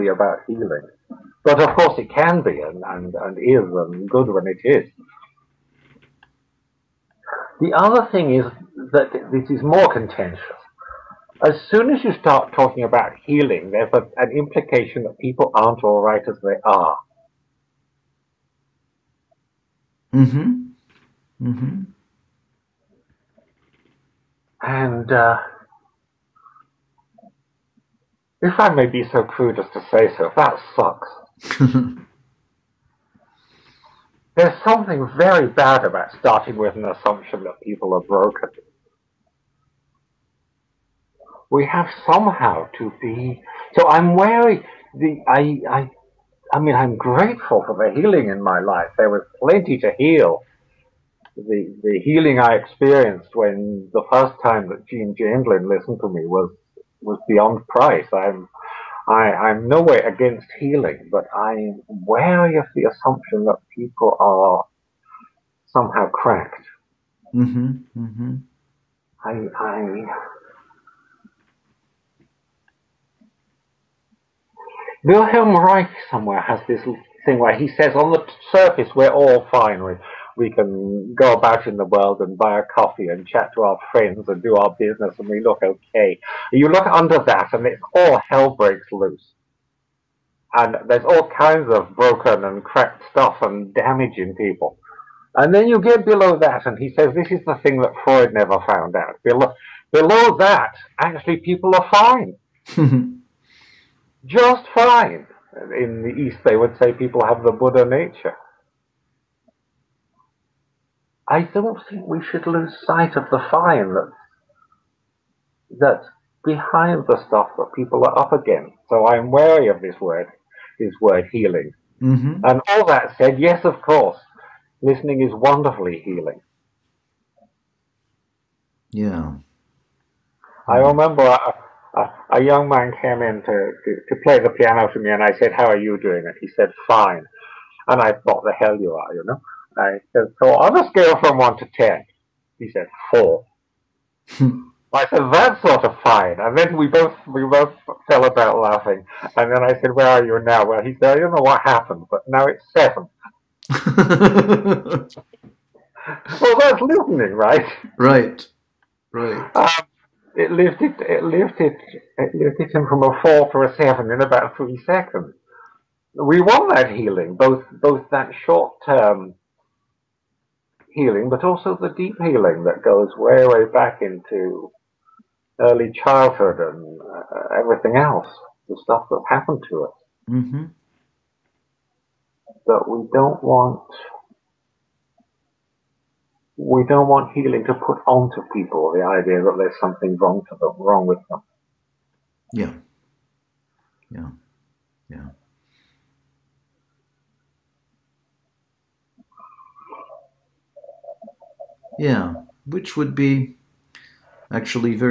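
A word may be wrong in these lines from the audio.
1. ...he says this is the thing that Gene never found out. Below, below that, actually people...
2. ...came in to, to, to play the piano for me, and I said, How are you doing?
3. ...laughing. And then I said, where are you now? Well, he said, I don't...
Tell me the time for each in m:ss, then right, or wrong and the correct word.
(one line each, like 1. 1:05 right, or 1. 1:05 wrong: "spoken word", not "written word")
1. 1:36 wrong: "Freud", not "Gene"
2. 2:13 right
3. 2:28 right.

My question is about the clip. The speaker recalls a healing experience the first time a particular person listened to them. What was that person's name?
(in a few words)
Gene Chamberlain.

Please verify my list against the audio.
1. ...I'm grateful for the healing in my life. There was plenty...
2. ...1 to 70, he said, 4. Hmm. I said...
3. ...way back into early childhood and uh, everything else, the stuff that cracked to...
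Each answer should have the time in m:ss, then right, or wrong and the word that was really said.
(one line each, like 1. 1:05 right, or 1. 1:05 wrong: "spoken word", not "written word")
1. 0:46 right
2. 2:21 wrong: "10", not "70"
3. 2:53 wrong: "happened", not "cracked".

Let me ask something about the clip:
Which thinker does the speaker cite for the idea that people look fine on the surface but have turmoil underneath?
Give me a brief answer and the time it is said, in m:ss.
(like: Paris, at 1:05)
Wilhelm Reich, at 1:15.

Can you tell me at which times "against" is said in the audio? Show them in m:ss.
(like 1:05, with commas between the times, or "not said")
0:59, 1:58.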